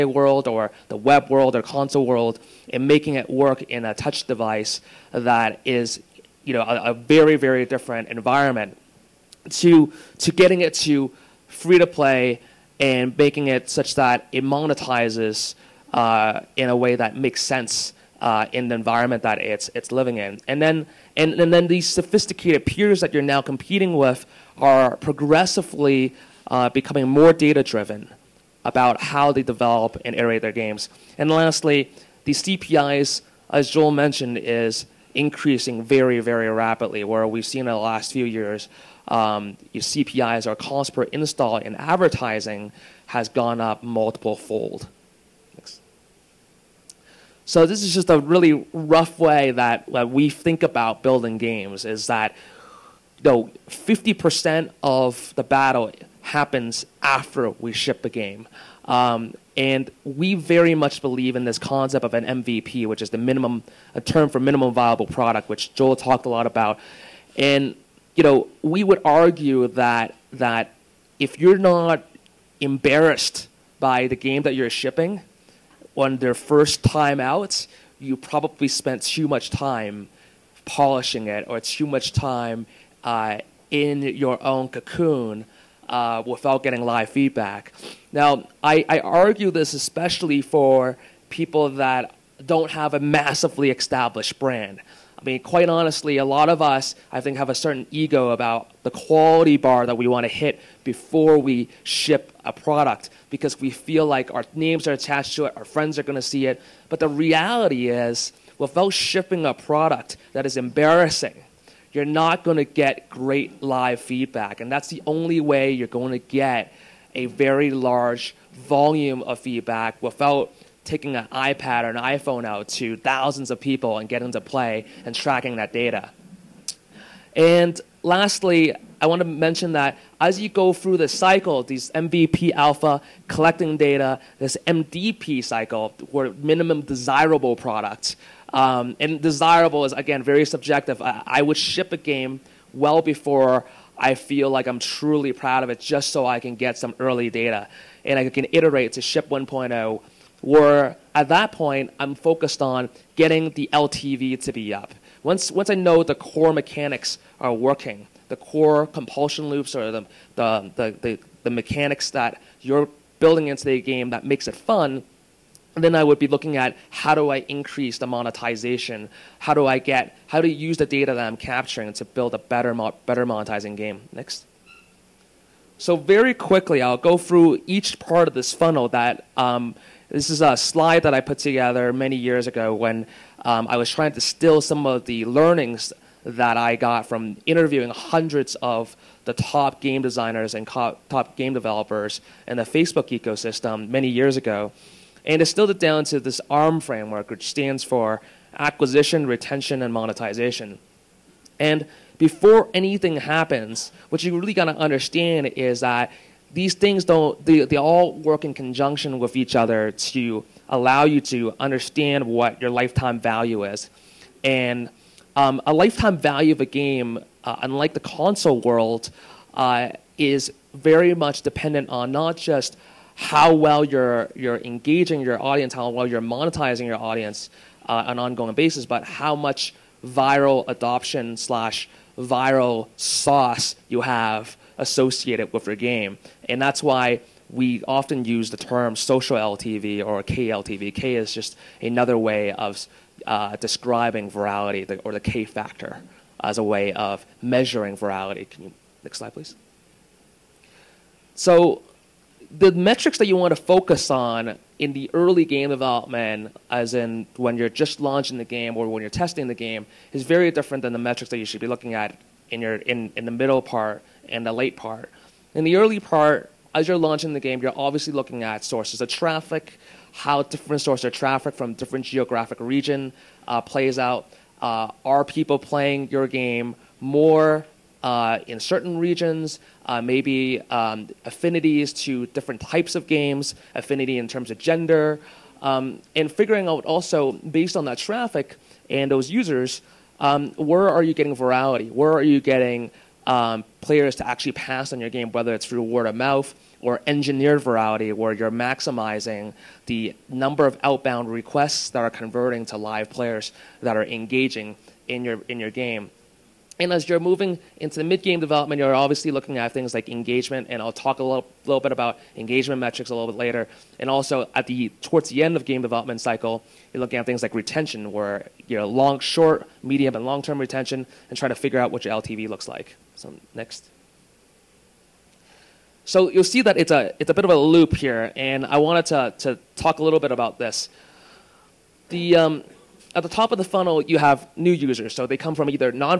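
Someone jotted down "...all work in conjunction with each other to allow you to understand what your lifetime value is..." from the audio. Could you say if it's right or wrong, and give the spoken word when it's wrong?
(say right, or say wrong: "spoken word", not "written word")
right.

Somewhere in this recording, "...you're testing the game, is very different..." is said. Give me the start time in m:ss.
4:19.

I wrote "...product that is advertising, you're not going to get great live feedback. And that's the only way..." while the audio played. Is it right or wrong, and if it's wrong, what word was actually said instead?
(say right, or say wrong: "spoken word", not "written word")
wrong: "embarrassing", not "advertising".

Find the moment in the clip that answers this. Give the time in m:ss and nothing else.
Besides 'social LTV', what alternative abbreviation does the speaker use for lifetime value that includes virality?
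4:00.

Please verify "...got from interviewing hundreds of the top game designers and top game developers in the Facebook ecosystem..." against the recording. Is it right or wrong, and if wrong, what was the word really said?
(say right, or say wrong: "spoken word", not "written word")
right.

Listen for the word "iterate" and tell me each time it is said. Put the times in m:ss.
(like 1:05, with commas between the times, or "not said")
0:30, 2:28.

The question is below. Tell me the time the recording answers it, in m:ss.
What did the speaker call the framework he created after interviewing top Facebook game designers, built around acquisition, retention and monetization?
3:16.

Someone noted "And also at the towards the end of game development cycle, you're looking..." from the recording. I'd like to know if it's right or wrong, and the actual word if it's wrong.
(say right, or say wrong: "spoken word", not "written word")
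right.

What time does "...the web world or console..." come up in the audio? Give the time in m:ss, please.
0:00.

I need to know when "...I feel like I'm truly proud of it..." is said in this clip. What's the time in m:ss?
2:23.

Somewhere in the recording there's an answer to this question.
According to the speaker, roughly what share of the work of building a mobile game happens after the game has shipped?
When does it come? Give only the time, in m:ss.
0:53.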